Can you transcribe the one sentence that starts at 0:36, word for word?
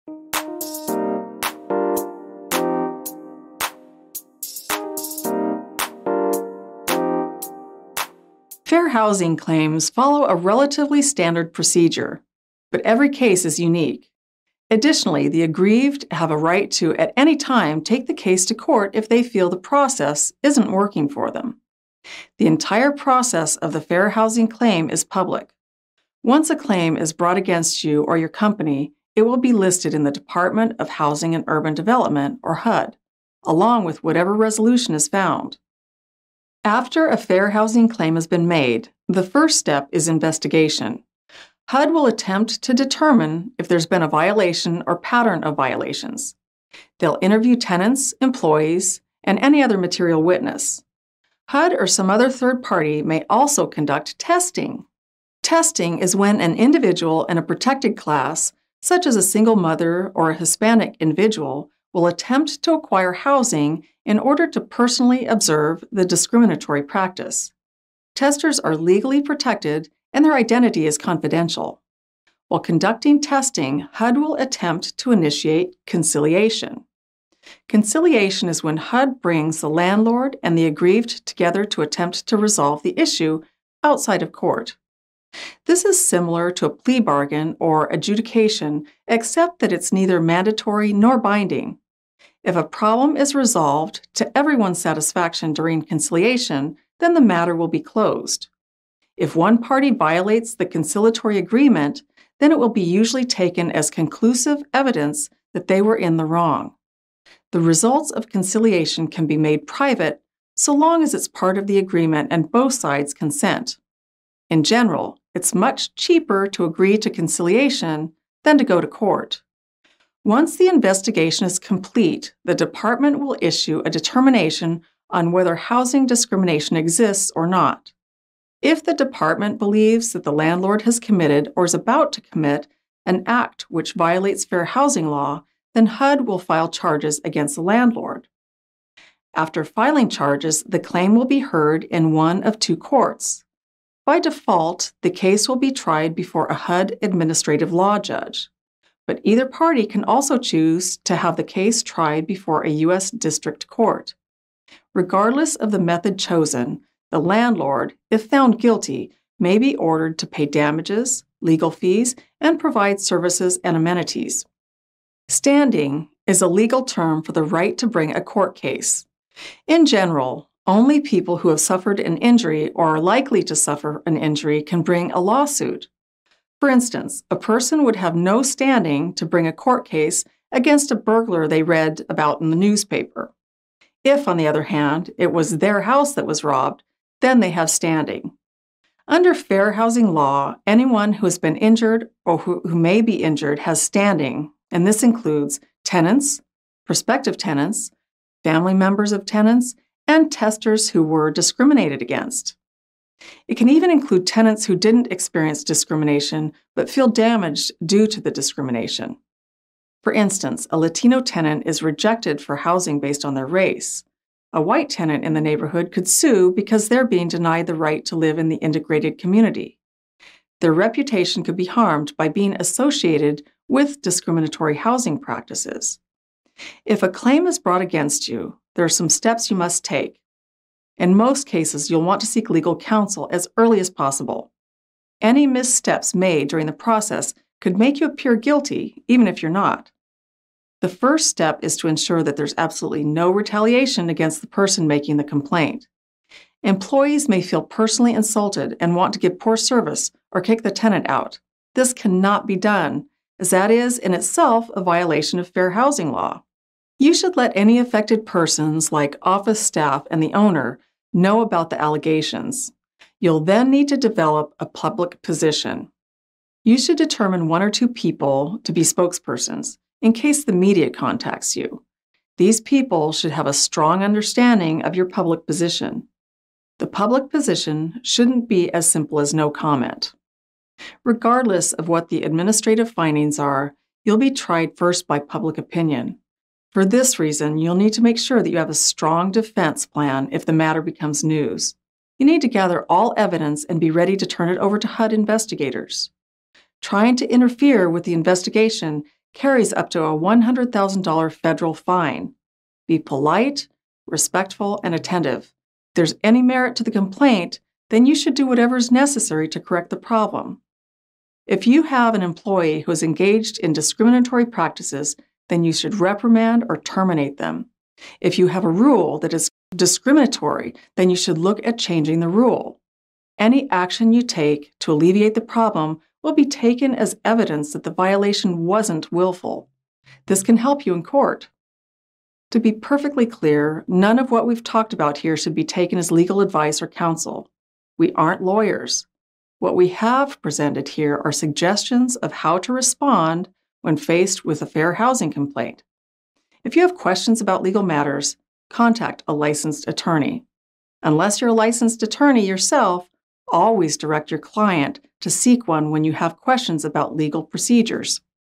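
After a fair housing claim has been made, the first step is investigation.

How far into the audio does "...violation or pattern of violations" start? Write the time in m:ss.
0:44.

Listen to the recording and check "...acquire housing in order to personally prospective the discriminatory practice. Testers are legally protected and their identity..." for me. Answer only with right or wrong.
wrong.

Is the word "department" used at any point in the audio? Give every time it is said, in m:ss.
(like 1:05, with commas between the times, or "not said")
0:30, 2:02, 2:08.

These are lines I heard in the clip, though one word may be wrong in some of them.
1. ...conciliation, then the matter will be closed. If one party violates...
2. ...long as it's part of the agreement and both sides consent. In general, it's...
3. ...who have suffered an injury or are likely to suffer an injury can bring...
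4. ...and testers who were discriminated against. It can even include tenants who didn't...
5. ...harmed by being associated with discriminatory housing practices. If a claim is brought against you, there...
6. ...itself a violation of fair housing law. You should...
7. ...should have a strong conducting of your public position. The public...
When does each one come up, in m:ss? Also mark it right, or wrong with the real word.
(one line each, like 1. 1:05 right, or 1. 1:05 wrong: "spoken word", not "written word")
1. 1:35 right
2. 1:50 right
3. 2:51 right
4. 3:20 right
5. 3:41 right
6. 4:14 right
7. 4:33 wrong: "understanding", not "conducting".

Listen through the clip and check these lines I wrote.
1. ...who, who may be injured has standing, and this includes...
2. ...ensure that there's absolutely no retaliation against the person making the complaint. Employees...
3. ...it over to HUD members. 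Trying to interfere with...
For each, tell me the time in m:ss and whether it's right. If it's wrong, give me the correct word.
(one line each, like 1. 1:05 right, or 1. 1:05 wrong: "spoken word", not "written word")
1. 3:12 right
2. 4:01 right
3. 4:54 wrong: "investigators", not "members".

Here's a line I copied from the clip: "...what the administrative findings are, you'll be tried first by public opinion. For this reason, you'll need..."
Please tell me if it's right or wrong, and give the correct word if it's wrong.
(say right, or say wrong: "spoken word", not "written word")
right.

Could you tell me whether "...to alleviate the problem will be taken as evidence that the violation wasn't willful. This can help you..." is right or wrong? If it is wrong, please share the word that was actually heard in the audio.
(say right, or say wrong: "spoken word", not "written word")
right.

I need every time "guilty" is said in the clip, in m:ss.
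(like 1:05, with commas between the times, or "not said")
2:38, 3:58.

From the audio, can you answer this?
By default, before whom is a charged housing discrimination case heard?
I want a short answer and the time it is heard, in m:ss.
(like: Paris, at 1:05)
HUD administrative law judge, at 2:26.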